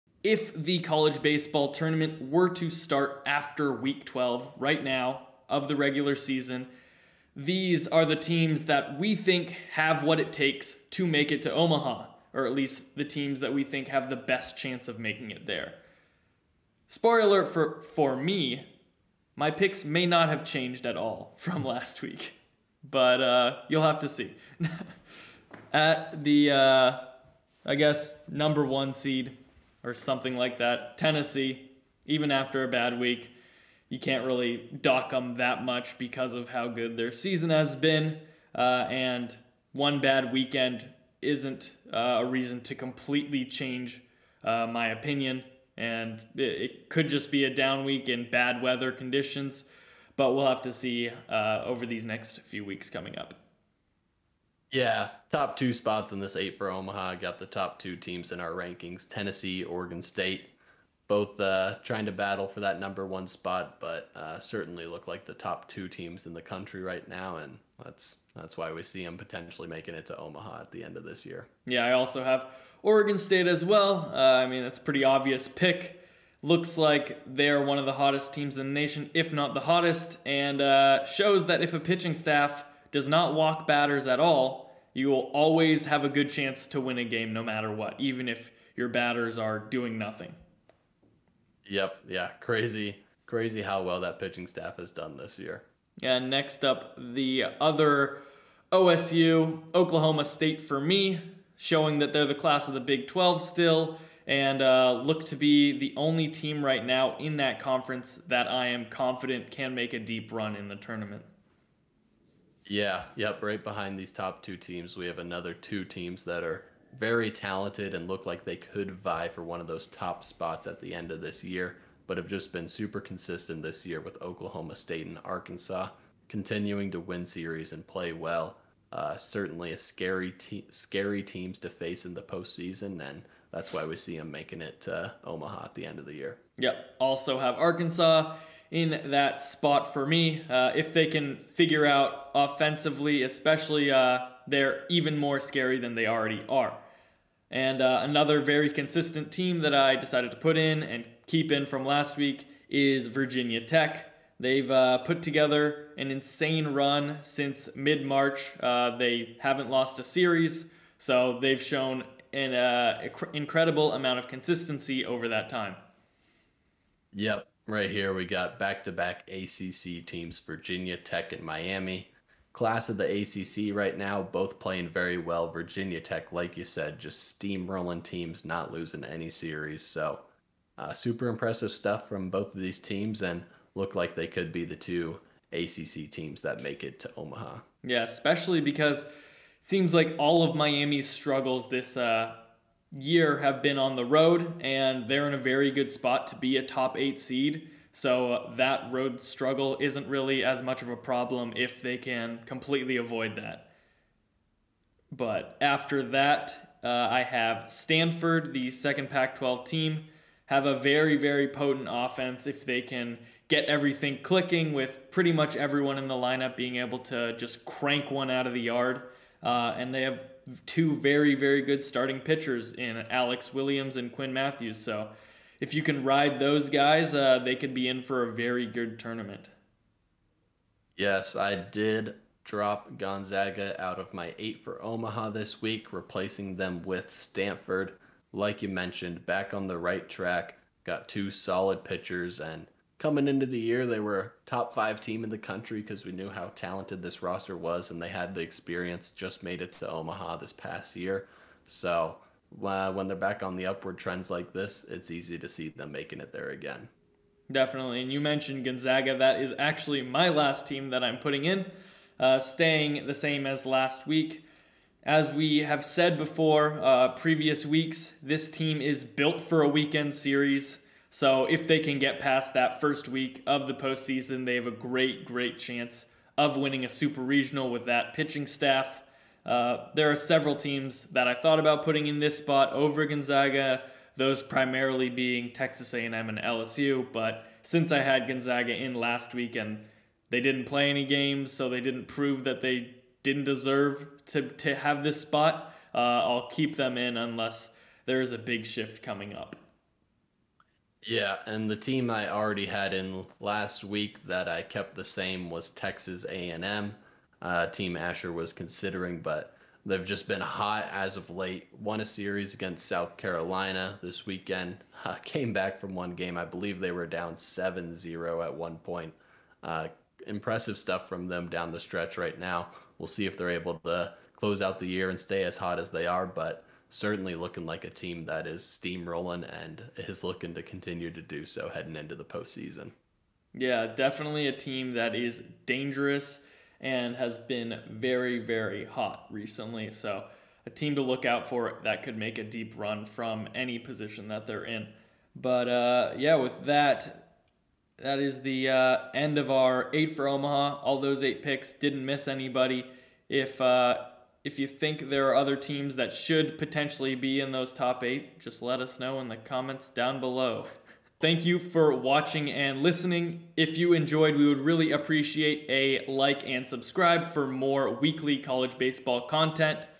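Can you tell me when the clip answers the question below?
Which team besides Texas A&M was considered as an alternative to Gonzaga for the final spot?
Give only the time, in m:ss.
4:46.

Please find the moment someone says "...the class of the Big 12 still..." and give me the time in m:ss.
1:42.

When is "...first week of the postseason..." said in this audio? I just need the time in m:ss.
4:32.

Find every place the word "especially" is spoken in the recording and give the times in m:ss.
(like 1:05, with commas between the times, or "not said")
2:23, 3:08.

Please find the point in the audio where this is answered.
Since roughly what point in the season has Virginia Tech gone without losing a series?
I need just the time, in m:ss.
2:37.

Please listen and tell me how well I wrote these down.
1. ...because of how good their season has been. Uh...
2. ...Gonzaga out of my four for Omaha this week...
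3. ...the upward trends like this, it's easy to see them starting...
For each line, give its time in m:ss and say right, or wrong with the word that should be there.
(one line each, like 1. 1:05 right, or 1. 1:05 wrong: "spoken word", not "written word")
1. 0:35 right
2. 3:52 wrong: "eight", not "four"
3. 4:13 wrong: "making", not "starting".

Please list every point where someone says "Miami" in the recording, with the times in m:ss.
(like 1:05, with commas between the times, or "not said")
2:51, 3:10.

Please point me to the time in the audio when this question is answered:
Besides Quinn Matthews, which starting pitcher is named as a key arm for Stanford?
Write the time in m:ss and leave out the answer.
3:43.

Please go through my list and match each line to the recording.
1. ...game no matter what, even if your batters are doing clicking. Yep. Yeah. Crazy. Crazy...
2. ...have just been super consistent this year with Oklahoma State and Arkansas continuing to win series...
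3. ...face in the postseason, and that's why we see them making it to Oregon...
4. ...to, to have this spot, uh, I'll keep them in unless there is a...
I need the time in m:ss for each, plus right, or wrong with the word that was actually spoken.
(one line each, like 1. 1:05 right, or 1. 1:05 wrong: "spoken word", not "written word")
1. 1:27 wrong: "nothing", not "clicking"
2. 2:02 right
3. 2:11 wrong: "Omaha", not "Oregon"
4. 4:54 right.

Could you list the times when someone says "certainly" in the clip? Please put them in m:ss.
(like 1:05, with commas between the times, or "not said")
1:04, 2:09, 5:26.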